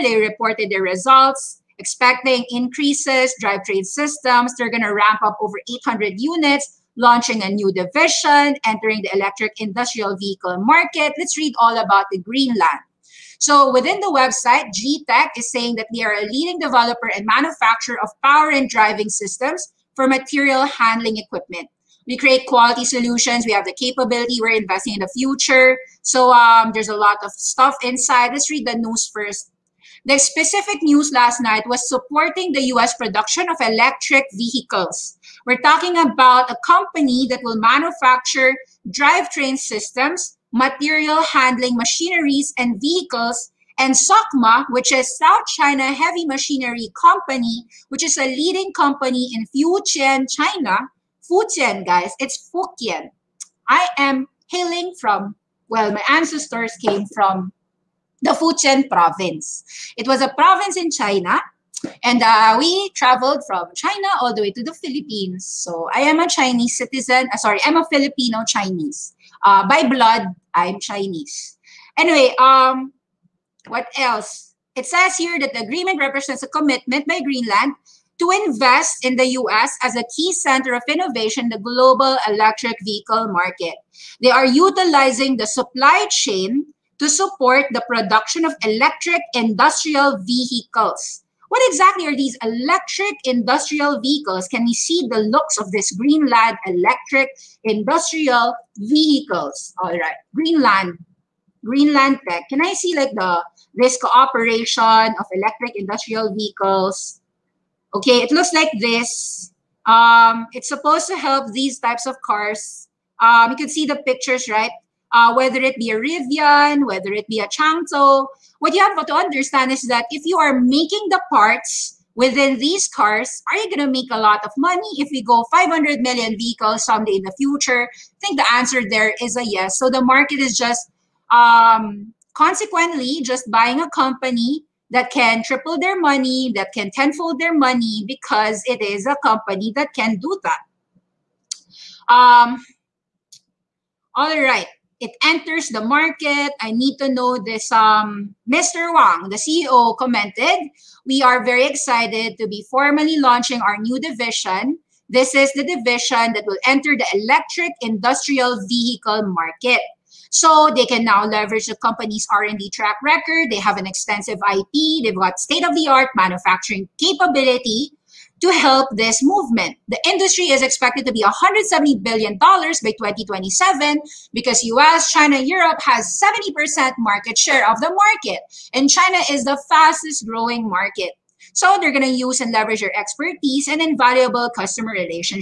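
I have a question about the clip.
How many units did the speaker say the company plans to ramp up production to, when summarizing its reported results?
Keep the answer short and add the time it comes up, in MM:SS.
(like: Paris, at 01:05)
over 800, at 00:05.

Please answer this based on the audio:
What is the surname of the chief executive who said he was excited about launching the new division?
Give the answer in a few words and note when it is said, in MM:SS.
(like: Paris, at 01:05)
Wang, at 02:28.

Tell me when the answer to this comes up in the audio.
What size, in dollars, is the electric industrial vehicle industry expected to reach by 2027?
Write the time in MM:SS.
02:51.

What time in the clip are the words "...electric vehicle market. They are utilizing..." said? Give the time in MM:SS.
01:22.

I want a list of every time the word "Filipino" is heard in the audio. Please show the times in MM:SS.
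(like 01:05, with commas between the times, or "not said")
01:07.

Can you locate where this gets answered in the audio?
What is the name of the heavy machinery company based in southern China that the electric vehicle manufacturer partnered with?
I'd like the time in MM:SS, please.
00:43.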